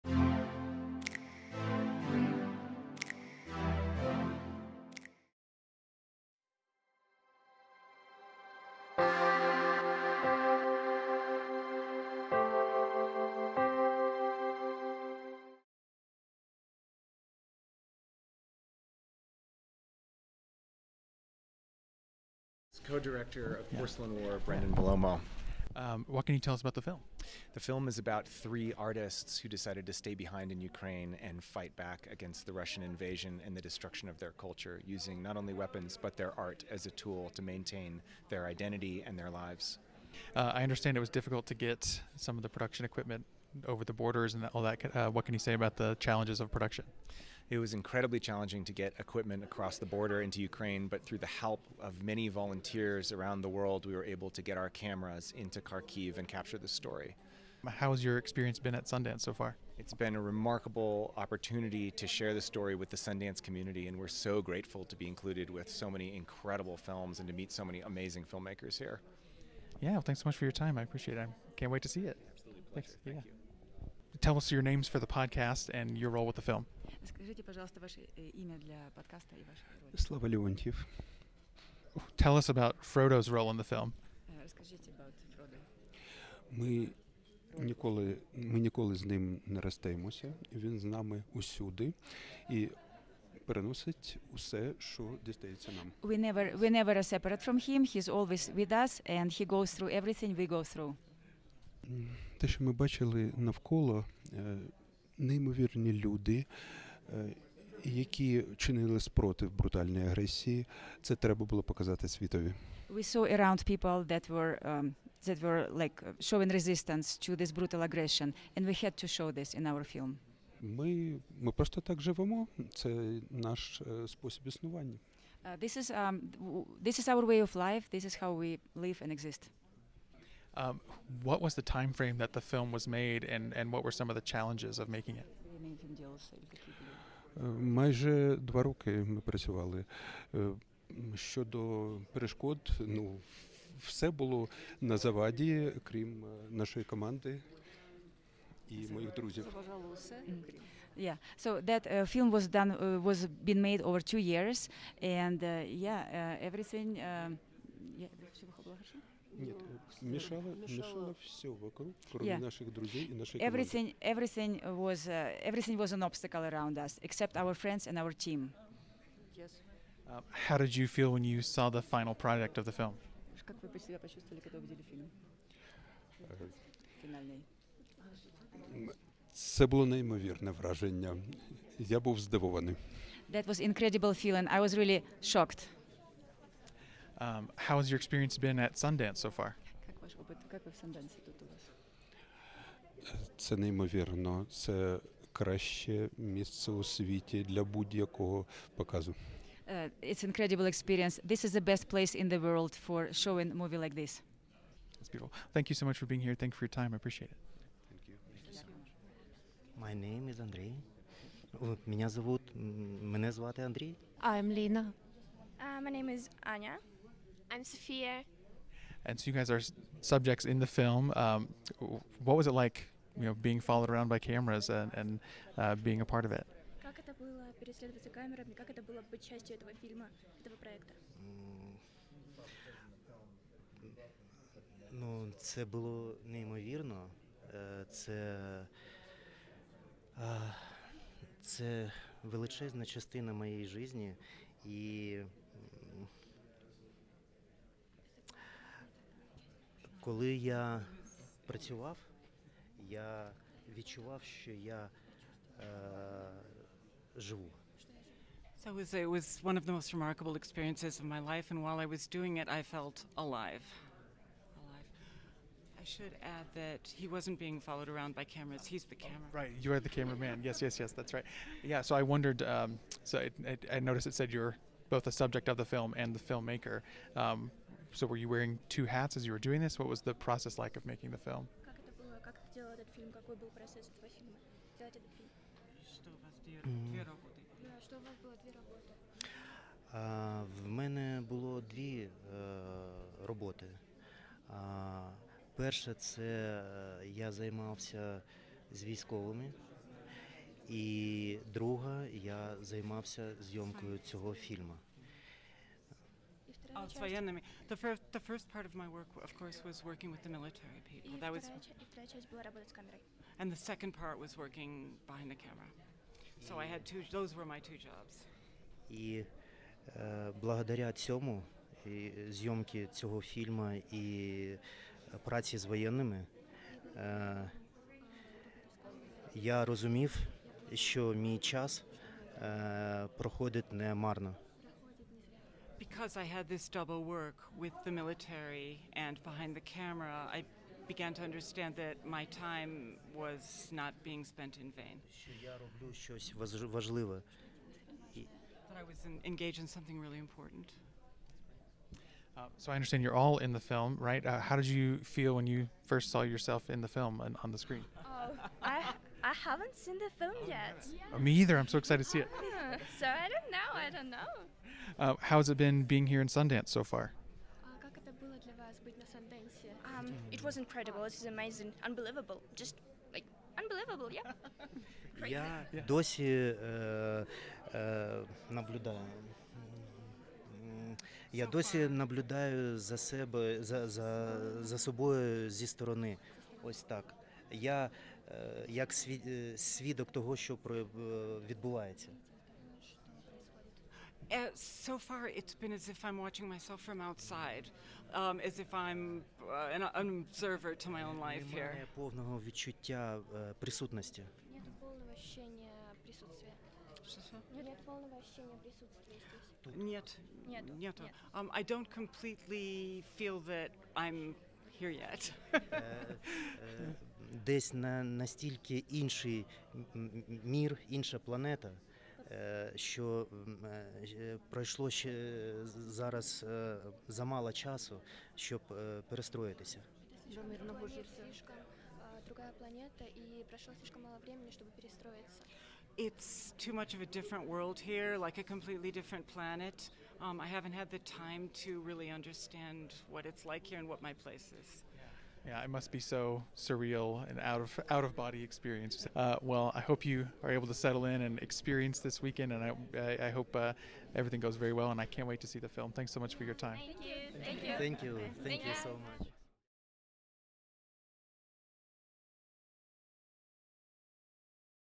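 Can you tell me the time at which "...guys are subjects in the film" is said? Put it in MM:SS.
03:39.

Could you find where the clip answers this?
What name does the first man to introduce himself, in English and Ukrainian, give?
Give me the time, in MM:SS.
03:30.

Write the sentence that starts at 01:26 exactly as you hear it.
Ми ніколи, ми ніколи з ним не розстаємося.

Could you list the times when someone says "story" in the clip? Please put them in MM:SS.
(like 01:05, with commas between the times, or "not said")
00:56, 01:02.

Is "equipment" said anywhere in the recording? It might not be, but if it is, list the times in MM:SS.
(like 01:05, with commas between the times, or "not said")
00:42, 00:48.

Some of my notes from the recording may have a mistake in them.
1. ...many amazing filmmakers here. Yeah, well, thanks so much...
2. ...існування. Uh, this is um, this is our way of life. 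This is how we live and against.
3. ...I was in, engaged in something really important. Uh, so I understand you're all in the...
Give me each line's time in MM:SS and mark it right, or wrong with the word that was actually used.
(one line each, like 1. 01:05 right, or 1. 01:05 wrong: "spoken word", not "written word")
1. 01:07 right
2. 02:04 wrong: "exist", not "against"
3. 05:48 right.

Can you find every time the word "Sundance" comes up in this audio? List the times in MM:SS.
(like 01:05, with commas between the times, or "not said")
00:58, 01:02, 03:08, 06:06.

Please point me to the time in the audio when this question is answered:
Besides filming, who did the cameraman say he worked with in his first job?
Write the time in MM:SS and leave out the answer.
05:10.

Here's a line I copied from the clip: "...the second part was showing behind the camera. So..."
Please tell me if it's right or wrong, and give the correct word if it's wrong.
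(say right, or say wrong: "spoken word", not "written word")
wrong: "working", not "showing".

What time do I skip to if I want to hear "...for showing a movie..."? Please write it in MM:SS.
03:22.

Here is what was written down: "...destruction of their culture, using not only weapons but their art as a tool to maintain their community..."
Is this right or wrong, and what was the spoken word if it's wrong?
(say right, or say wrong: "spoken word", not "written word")
wrong: "identity", not "community".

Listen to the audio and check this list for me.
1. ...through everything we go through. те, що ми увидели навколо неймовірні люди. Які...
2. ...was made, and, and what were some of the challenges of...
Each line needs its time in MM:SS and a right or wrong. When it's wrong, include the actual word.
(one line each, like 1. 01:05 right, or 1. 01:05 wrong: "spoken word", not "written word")
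1. 01:39 wrong: "бачили", not "увидели"
2. 02:12 right.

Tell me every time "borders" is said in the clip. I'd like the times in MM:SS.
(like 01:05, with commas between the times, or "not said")
00:43, 00:49.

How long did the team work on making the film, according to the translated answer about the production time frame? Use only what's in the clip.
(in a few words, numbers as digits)
2 years.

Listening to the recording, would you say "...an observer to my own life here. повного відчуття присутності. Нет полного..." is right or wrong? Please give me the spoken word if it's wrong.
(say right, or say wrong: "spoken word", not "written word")
right.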